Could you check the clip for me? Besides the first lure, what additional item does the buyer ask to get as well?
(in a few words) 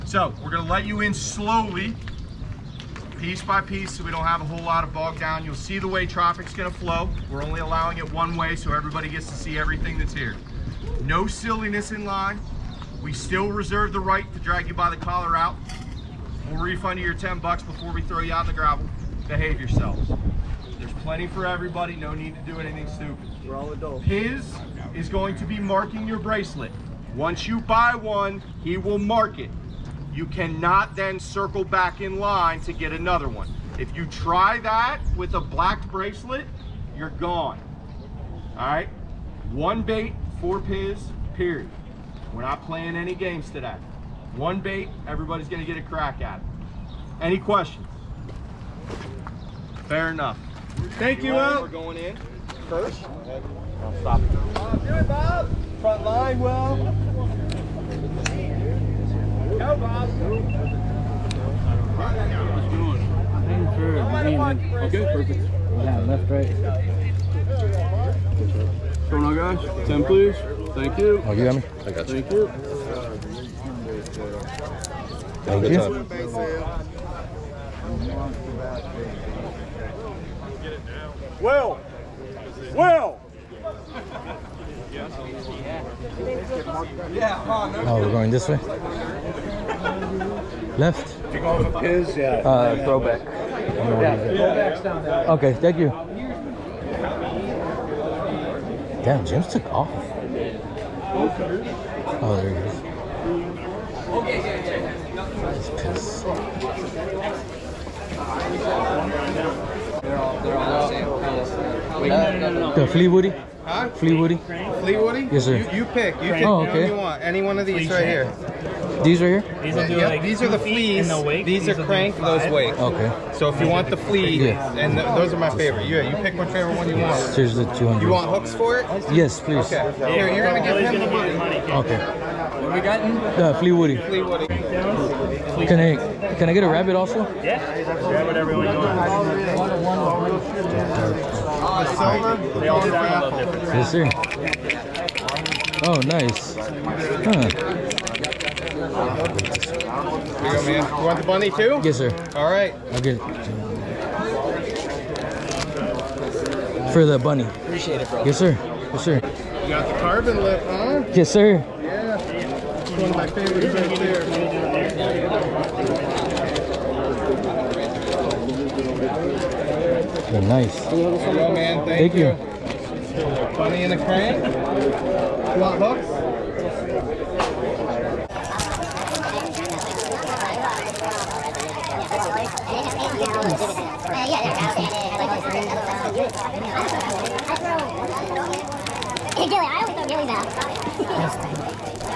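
rabbit.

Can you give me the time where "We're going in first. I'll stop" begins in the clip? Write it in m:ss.
0:51.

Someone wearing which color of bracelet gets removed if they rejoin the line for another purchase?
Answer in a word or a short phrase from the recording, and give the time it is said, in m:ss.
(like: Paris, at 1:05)
black, at 0:35.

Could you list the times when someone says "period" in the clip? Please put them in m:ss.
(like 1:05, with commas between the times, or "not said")
0:41.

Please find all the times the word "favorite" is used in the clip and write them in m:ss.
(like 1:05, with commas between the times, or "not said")
2:05, 2:43.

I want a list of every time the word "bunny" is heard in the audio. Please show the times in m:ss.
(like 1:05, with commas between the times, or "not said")
2:31, 2:37, 2:53.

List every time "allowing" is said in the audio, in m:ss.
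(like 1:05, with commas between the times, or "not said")
0:07.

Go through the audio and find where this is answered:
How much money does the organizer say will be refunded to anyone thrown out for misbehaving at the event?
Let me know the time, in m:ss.
0:17.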